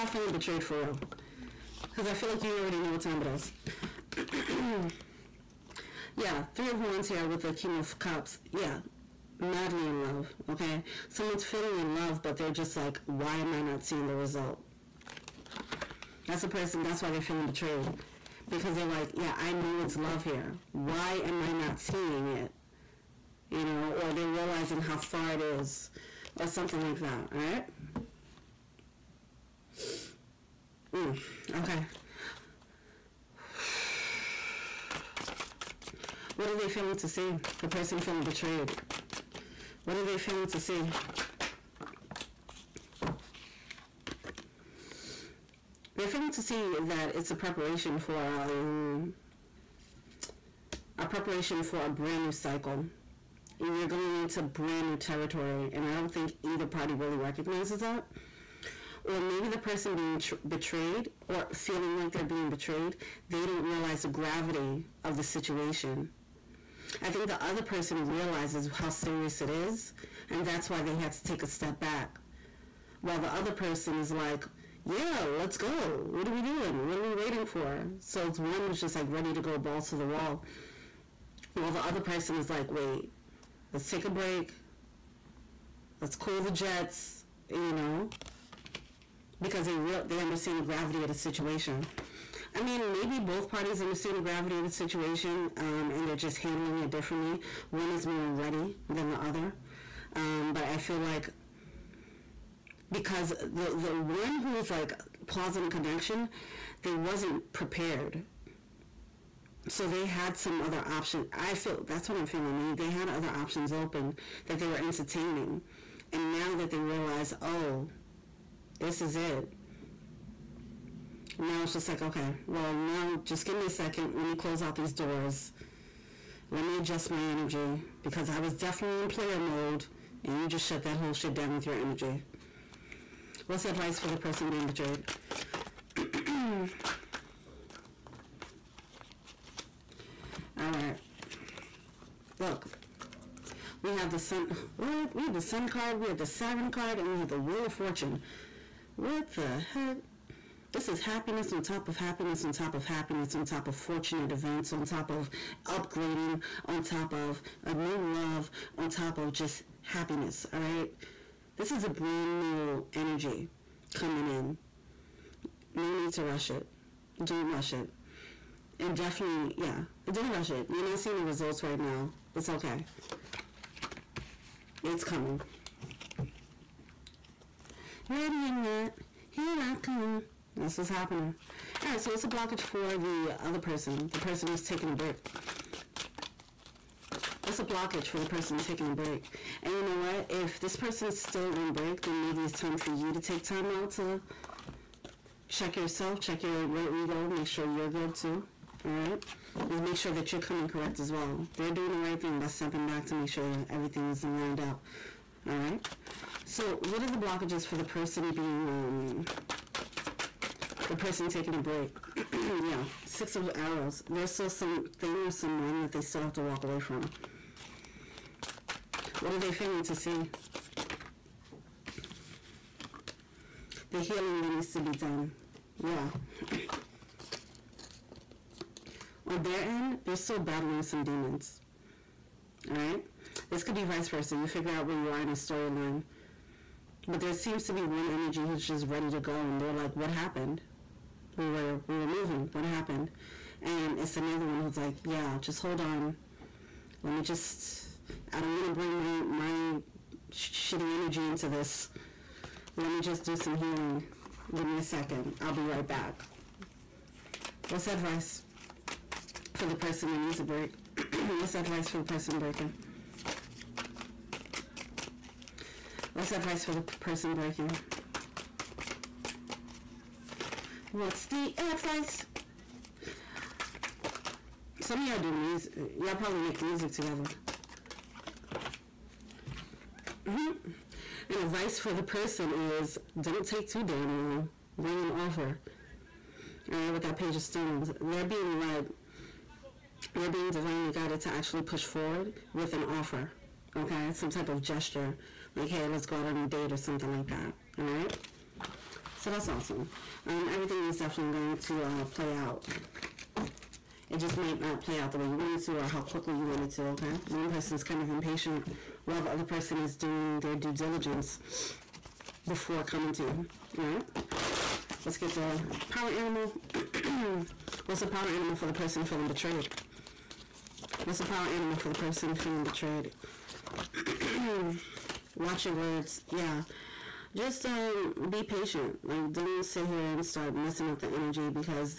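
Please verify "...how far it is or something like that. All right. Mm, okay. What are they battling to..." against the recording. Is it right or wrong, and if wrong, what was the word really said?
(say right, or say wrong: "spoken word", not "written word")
wrong: "feeling", not "battling".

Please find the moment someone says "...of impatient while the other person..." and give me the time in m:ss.
5:08.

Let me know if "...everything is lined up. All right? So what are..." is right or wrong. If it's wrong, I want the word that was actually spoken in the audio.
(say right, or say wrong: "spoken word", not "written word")
right.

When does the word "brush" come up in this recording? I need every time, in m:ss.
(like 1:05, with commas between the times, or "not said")
not said.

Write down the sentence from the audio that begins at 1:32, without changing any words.
I mean, maybe both parties understand the gravity of the situation um, and they're just handling it differently.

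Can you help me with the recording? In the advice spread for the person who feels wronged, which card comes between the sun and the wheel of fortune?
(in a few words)
Siren.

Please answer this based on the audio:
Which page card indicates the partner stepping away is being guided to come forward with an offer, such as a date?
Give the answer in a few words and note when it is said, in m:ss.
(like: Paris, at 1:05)
Page of Stones, at 4:47.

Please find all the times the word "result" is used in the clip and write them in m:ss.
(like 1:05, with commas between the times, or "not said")
0:14, 2:51.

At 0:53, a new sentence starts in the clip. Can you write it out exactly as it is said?
You're going into brand new territory, and I don't think either party really recognizes that.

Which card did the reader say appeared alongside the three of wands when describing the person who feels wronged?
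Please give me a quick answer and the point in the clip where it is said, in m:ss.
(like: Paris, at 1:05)
King of Cups, at 0:07.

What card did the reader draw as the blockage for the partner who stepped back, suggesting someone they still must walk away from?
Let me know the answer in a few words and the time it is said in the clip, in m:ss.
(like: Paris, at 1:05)
Six of Arrows, at 3:33.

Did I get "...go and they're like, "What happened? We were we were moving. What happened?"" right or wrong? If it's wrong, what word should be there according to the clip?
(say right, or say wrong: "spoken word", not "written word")
right.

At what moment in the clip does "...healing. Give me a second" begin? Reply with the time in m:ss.
4:13.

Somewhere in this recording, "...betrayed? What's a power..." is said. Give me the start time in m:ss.
5:19.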